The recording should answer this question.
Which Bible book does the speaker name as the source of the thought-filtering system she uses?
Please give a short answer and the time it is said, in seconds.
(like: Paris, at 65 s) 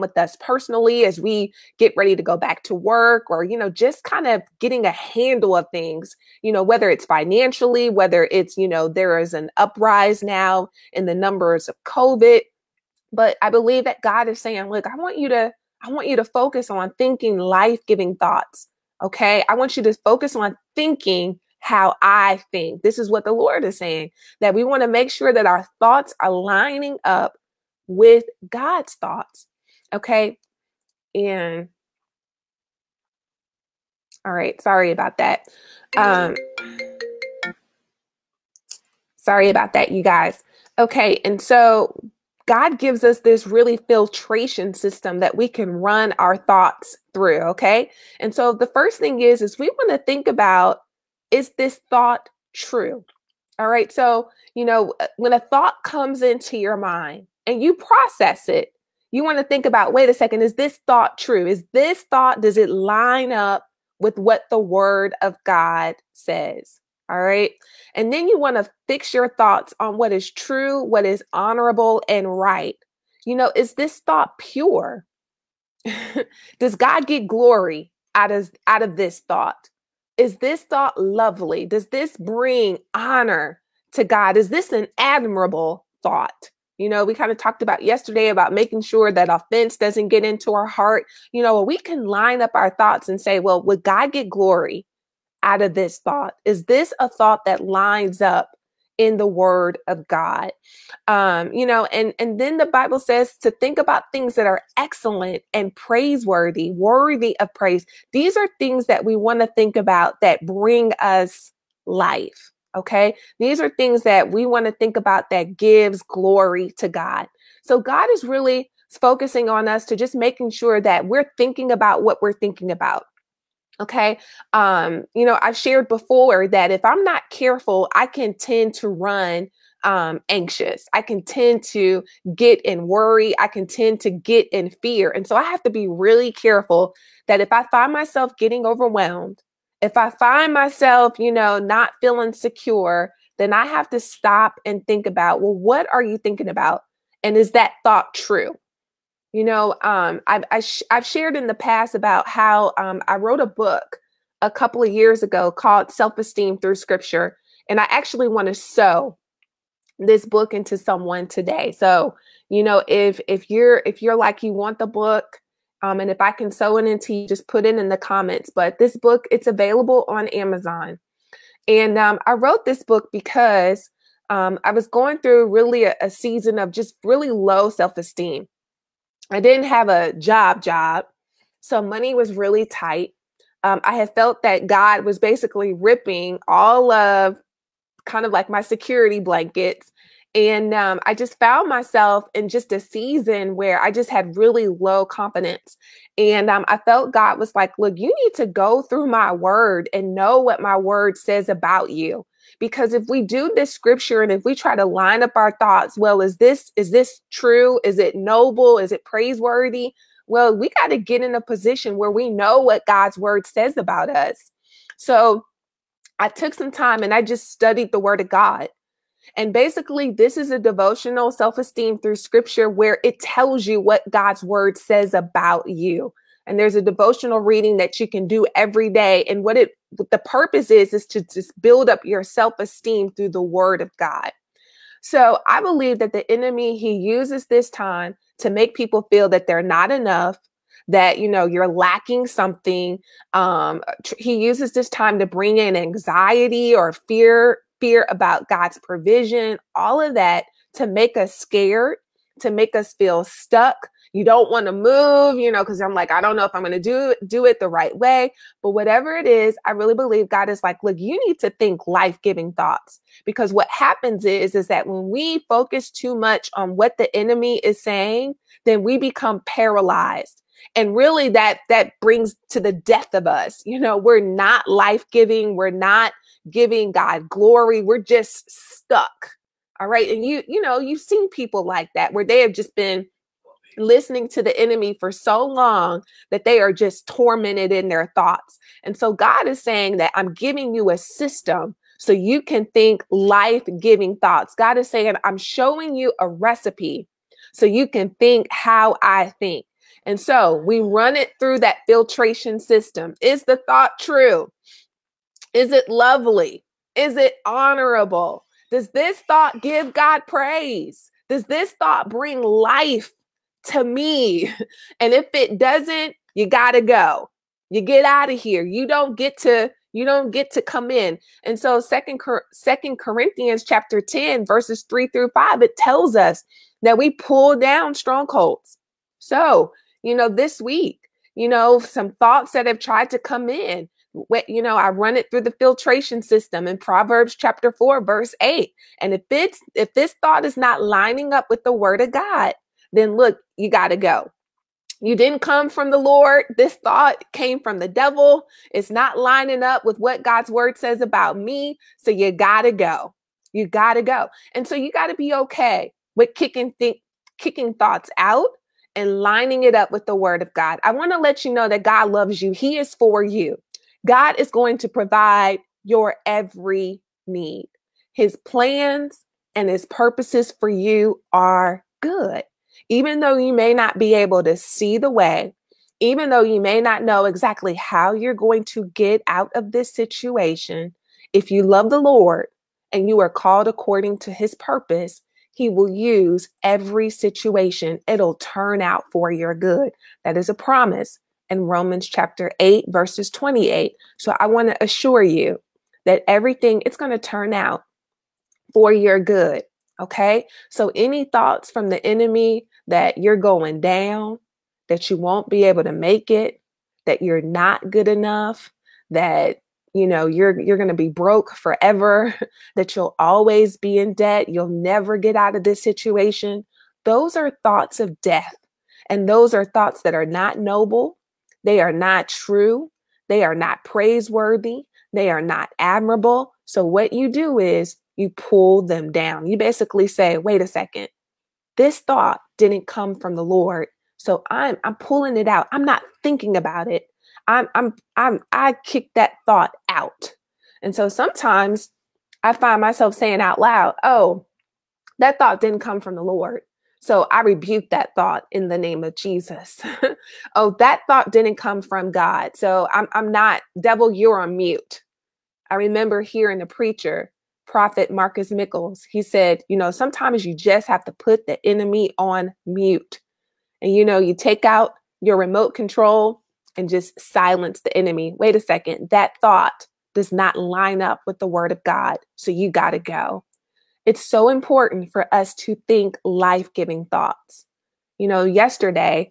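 Proverbs, at 336 s.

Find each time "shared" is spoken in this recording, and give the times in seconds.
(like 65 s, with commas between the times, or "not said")
125 s, 151 s.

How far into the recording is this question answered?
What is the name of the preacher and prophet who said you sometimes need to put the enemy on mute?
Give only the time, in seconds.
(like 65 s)
458 s.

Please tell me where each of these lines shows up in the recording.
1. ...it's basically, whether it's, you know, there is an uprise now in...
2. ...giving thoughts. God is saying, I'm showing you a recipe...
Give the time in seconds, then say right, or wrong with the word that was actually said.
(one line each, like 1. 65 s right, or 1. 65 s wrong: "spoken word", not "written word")
1. 6 s wrong: "financially", not "basically"
2. 293 s right.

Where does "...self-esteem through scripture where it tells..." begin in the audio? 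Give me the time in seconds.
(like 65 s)
221 s.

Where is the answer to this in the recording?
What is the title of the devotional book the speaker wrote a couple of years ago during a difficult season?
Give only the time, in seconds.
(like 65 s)
155 s.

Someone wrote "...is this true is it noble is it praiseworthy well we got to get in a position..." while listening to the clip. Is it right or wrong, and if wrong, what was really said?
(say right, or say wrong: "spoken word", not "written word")
right.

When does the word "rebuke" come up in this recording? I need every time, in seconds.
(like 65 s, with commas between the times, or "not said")
447 s.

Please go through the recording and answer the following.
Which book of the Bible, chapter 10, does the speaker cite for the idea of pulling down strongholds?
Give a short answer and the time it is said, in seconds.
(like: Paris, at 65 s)
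Second Corinthians, at 322 s.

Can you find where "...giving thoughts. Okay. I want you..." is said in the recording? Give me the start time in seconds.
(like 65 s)
17 s.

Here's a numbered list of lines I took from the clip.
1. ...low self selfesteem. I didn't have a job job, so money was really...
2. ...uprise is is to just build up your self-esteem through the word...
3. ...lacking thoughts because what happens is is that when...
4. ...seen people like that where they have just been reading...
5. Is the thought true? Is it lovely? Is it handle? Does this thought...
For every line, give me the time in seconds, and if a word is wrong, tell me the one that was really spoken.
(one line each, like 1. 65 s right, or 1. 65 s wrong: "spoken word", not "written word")
1. 177 s wrong: "esteem", not "selfesteem"
2. 230 s wrong: "purpose", not "uprise"
3. 262 s wrong: "giving", not "lacking"
4. 281 s wrong: "listening", not "reading"
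5. 303 s wrong: "honorable", not "handle".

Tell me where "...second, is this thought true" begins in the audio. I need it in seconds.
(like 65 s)
60 s.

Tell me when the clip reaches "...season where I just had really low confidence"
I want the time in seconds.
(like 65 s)
192 s.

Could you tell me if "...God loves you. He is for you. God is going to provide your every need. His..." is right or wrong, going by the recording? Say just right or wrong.
right.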